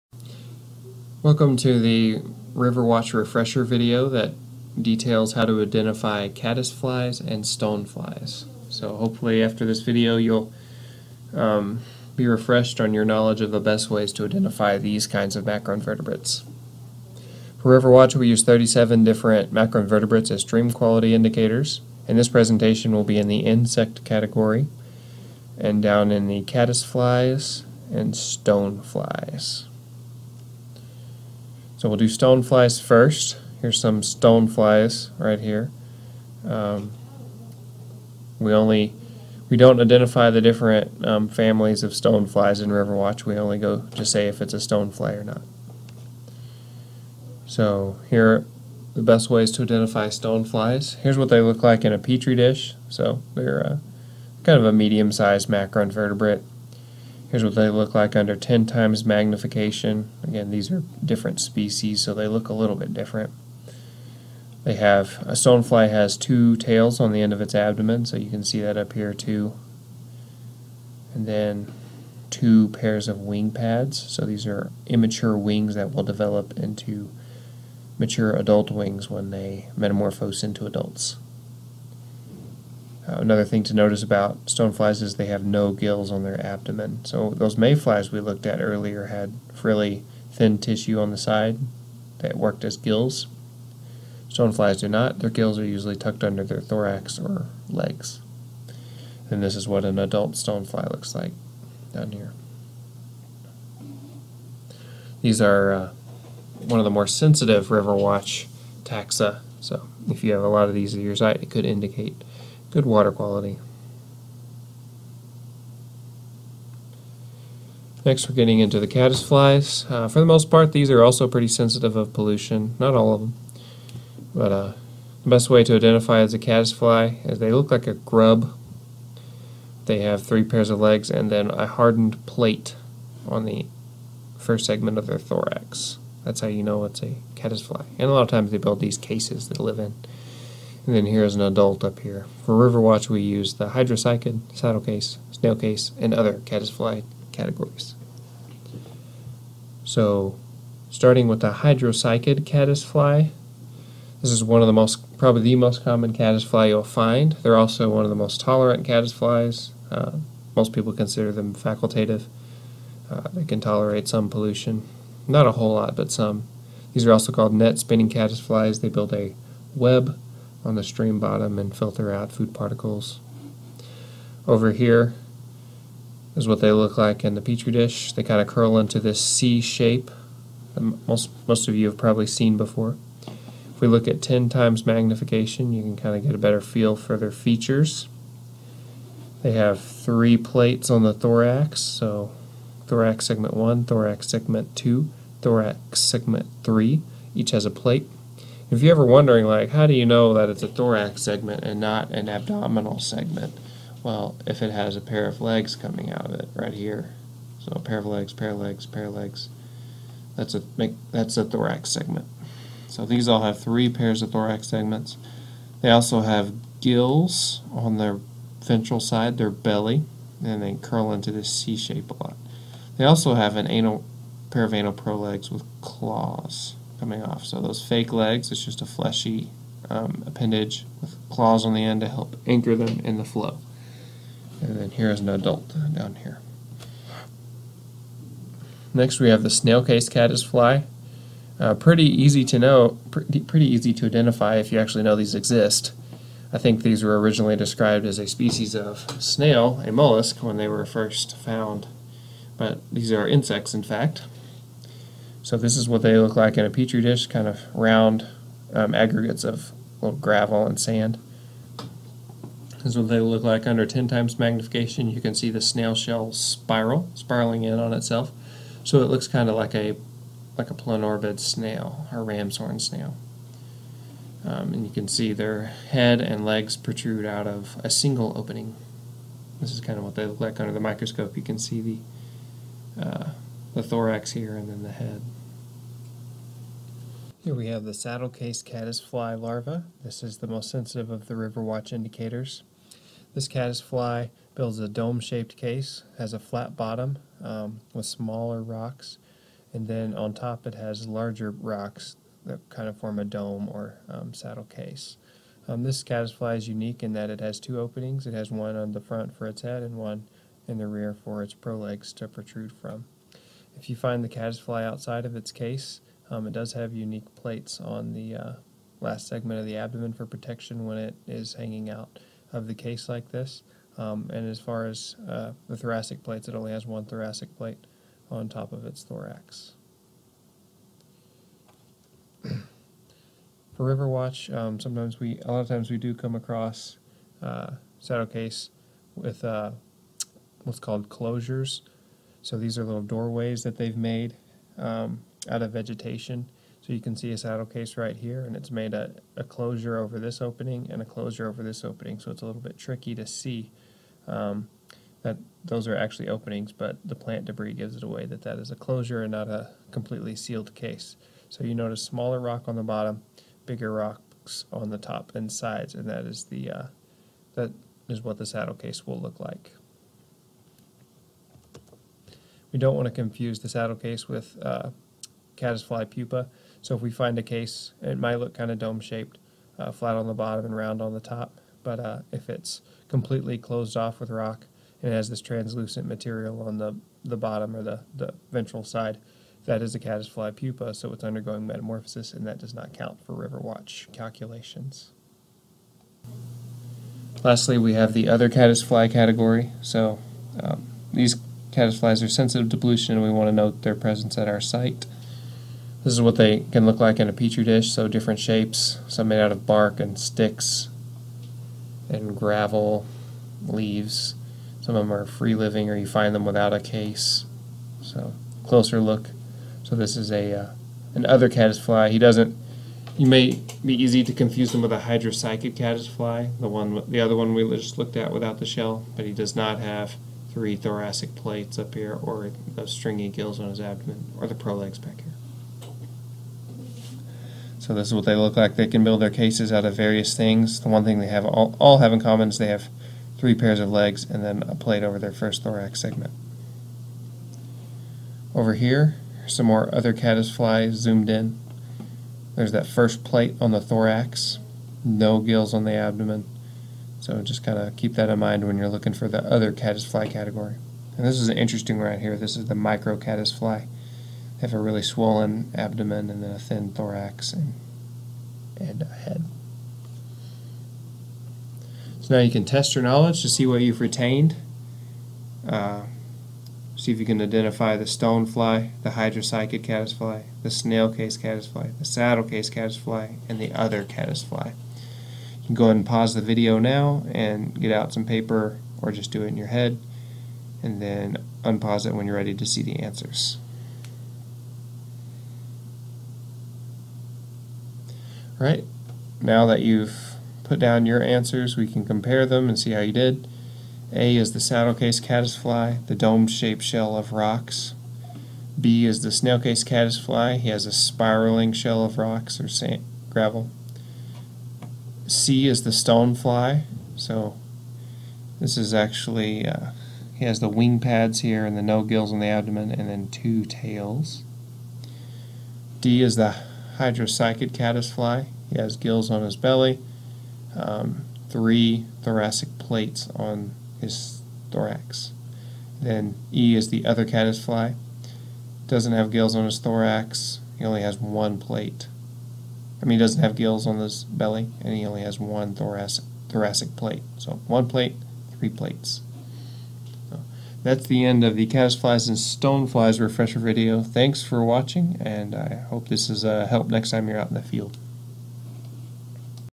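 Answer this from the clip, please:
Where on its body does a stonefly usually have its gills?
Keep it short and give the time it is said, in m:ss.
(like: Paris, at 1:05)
under their thorax or legs, at 1:35.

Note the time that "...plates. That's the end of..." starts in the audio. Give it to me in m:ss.
9:08.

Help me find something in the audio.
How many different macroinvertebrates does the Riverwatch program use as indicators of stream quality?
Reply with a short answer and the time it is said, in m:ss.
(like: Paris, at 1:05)
37, at 0:18.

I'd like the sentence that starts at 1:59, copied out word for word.
Uh, for the most part, these are also pretty sensitive of pollution.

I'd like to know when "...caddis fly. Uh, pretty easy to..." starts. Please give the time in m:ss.
4:00.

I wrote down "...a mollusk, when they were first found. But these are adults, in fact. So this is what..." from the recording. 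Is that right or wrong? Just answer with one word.
wrong.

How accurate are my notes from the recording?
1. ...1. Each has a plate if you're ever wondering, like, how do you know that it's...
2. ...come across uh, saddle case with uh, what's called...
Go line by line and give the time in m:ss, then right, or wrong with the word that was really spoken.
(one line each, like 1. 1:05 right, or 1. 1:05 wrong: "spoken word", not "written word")
1. 3:16 wrong: "3", not "1"
2. 5:36 right.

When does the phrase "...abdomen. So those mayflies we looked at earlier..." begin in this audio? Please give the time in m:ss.
1:26.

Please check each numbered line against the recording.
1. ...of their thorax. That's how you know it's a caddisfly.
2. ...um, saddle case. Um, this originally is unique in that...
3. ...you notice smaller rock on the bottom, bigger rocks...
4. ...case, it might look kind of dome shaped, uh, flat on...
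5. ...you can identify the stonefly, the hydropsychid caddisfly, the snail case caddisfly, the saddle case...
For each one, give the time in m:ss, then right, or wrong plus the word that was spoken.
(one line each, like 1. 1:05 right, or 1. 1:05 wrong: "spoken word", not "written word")
1. 2:14 right
2. 5:04 wrong: "caddisfly", not "originally"
3. 6:01 right
4. 6:17 right
5. 7:57 right.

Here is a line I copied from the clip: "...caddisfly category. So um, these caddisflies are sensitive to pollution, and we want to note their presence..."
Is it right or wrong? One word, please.
right.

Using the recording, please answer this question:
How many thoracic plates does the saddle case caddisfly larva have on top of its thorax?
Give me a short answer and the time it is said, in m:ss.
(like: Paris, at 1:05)
1, at 5:26.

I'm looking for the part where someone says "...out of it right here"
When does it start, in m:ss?
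3:26.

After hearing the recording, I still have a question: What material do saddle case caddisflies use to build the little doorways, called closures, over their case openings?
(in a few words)
vegetation.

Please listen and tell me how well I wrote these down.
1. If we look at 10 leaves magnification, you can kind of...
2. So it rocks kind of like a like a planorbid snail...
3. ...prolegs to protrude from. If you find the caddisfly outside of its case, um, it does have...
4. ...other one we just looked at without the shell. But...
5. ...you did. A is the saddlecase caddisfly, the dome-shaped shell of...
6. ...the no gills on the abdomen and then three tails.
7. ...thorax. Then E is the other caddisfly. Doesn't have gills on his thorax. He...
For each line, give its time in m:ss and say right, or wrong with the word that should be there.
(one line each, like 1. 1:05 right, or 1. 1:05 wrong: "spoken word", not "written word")
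1. 3:03 wrong: "times", not "leaves"
2. 4:28 wrong: "looks", not "rocks"
3. 5:11 right
4. 7:07 right
5. 8:22 right
6. 8:41 wrong: "two", not "three"
7. 8:54 right.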